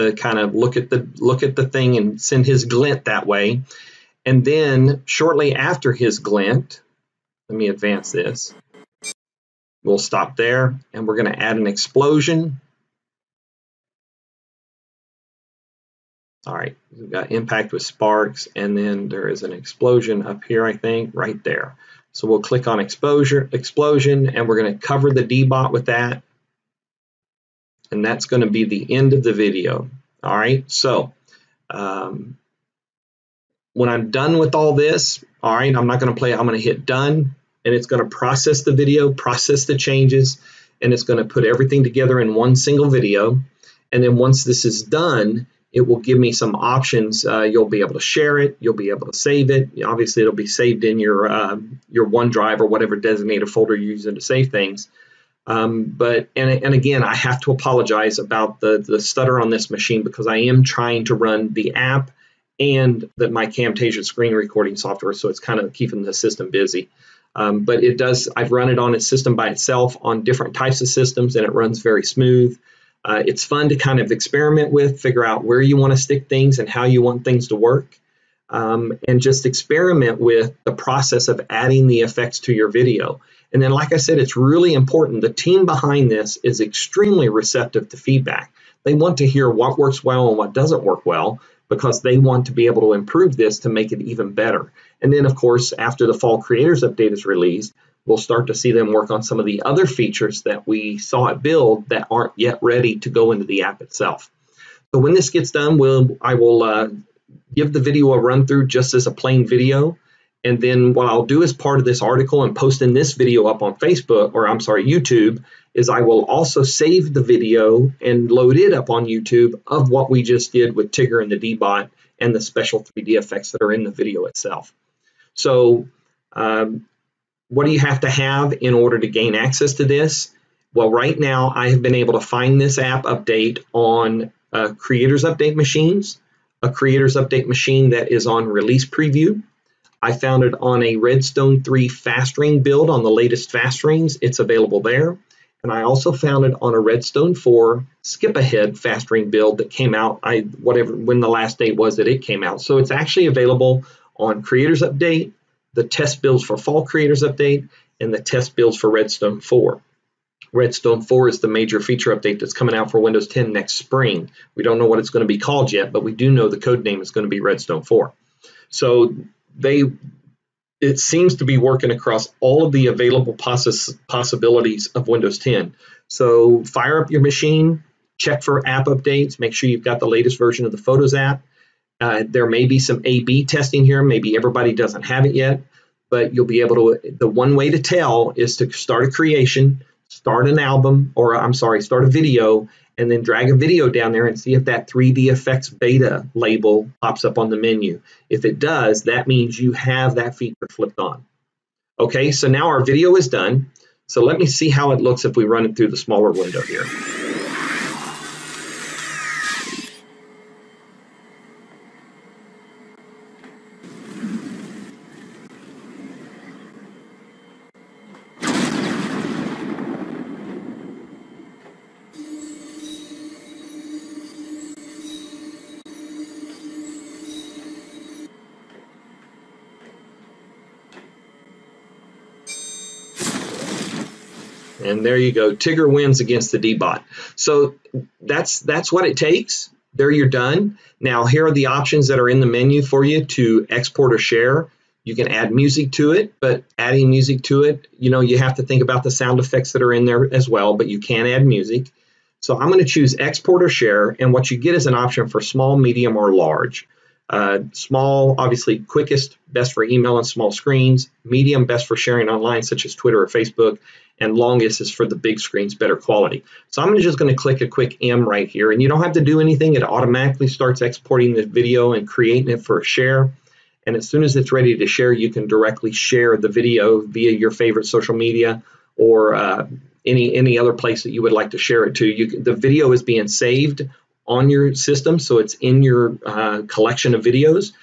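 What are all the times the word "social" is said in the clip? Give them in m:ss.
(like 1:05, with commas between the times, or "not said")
4:37.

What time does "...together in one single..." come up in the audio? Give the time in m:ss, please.
0:41.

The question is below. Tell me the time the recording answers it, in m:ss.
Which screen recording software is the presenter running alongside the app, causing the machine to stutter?
1:03.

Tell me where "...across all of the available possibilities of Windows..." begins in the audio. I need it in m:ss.
2:51.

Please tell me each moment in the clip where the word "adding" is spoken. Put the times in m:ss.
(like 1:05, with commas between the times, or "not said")
1:21, 4:06.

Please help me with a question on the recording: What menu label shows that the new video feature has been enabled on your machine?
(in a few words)
3D effects beta.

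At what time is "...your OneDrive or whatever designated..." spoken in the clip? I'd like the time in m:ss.
0:51.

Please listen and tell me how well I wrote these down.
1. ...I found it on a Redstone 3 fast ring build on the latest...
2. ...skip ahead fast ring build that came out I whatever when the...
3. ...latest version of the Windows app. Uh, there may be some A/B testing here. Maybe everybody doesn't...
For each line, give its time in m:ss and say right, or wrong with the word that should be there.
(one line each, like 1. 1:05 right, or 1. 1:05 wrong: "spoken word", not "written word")
1. 2:20 right
2. 2:28 right
3. 3:00 wrong: "Photos", not "Windows".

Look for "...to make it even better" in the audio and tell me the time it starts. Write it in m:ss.
1:33.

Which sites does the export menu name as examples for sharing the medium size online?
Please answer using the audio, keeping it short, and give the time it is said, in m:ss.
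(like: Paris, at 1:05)
Twitter or Facebook, at 4:22.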